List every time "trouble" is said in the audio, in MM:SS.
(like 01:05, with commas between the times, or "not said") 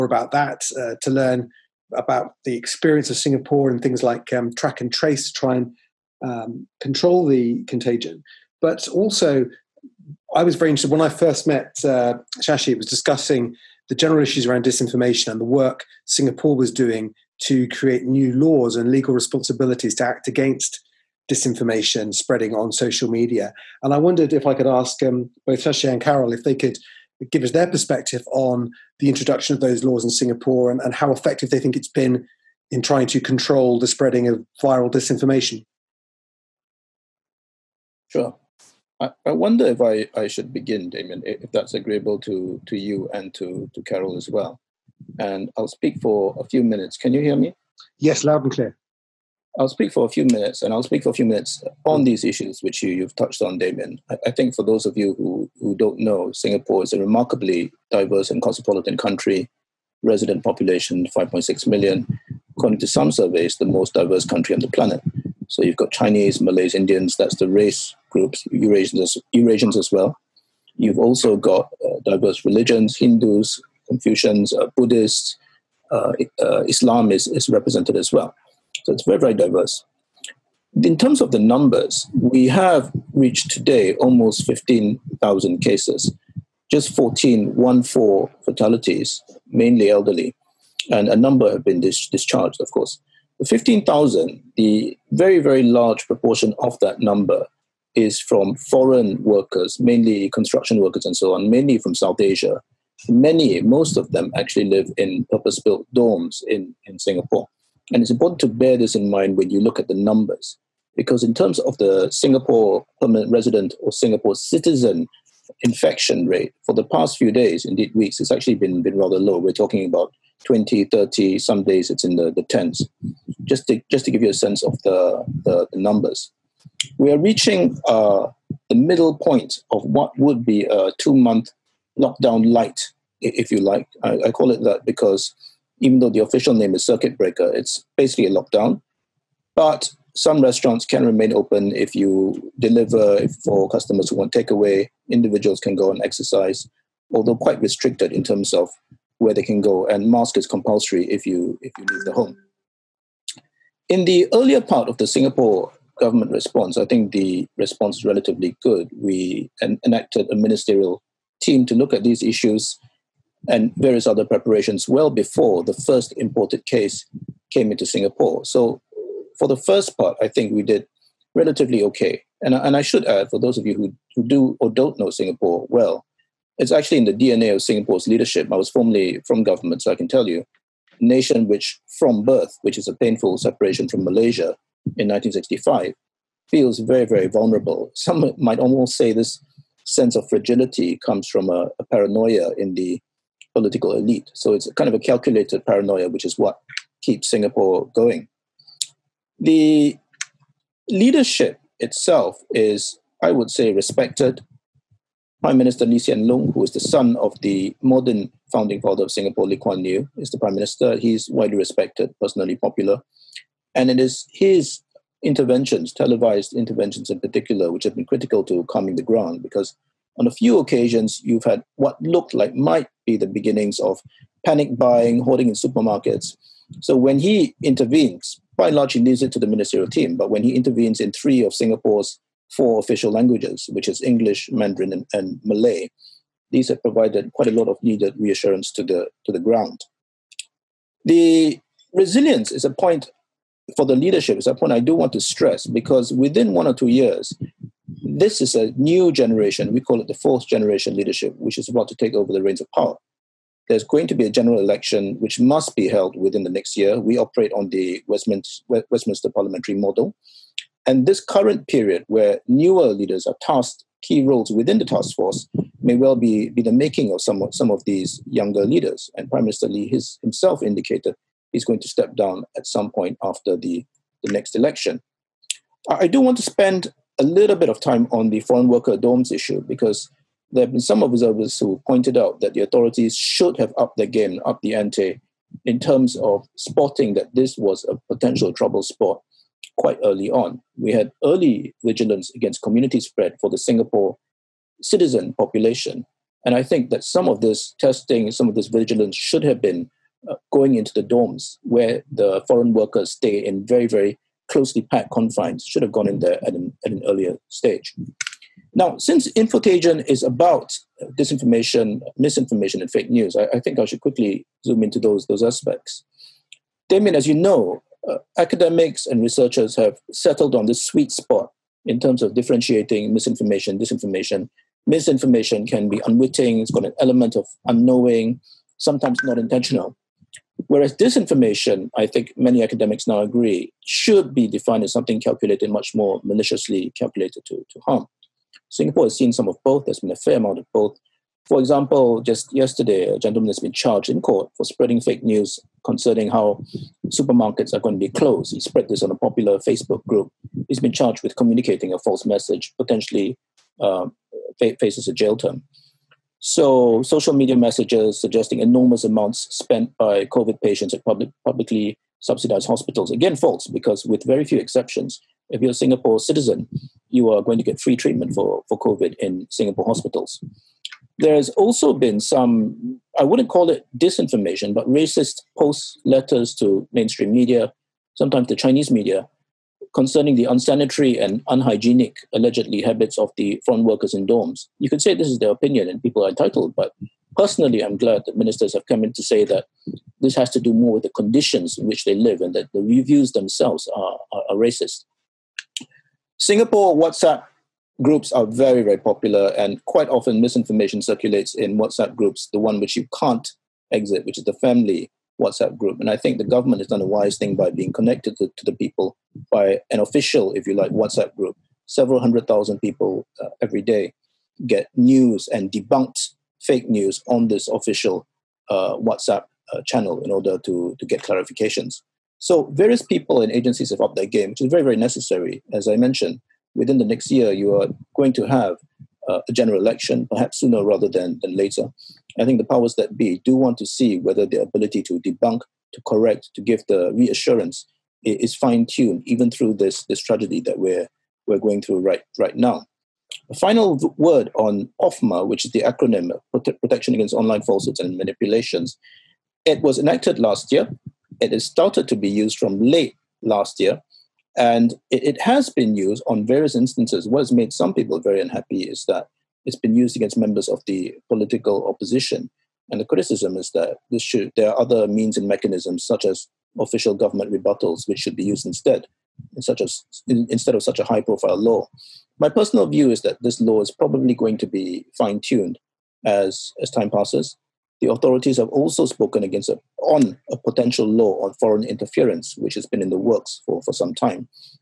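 04:48.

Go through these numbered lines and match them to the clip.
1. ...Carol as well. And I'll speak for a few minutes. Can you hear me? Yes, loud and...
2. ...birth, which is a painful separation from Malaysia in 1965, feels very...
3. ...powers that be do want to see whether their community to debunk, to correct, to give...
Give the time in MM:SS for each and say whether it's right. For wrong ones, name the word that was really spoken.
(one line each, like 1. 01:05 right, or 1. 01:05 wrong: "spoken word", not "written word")
1. 00:43 right
2. 03:02 right
3. 07:12 wrong: "ability", not "community".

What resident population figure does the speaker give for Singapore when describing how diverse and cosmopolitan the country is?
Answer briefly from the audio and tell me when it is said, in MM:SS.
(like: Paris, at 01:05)
5.6 million, at 01:01.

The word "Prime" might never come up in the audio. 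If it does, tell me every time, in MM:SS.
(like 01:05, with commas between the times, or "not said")
03:25, 03:30, 04:29.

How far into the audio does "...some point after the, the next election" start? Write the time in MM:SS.
04:32.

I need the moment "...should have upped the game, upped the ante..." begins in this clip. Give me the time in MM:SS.
04:43.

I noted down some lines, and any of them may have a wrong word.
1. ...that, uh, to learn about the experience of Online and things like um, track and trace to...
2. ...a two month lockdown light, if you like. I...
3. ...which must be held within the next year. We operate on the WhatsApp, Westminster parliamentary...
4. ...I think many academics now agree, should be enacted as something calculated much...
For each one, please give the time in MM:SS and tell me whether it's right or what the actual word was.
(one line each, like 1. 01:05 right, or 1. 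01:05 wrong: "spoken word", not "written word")
1. 00:00 wrong: "Singapore", not "Online"
2. 02:10 right
3. 04:15 wrong: "Westminster", not "WhatsApp"
4. 05:31 wrong: "defined", not "enacted".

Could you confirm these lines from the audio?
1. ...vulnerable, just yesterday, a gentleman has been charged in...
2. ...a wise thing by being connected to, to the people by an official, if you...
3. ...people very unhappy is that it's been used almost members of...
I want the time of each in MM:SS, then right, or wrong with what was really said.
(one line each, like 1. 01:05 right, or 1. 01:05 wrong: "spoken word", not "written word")
1. 05:41 wrong: "example", not "vulnerable"
2. 06:47 right
3. 07:37 wrong: "against", not "almost".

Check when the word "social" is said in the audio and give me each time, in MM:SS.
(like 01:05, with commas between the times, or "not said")
00:22, 05:57.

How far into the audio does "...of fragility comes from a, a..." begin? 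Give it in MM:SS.
03:10.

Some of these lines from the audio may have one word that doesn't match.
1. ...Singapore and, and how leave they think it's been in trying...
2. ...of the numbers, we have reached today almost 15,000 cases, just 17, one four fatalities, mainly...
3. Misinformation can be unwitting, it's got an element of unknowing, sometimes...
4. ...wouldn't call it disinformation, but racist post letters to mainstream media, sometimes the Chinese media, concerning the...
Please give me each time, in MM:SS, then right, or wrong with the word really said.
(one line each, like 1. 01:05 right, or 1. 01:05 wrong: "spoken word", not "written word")
1. 00:30 wrong: "effective", not "leave"
2. 01:21 wrong: "14", not "17"
3. 05:24 right
4. 06:13 right.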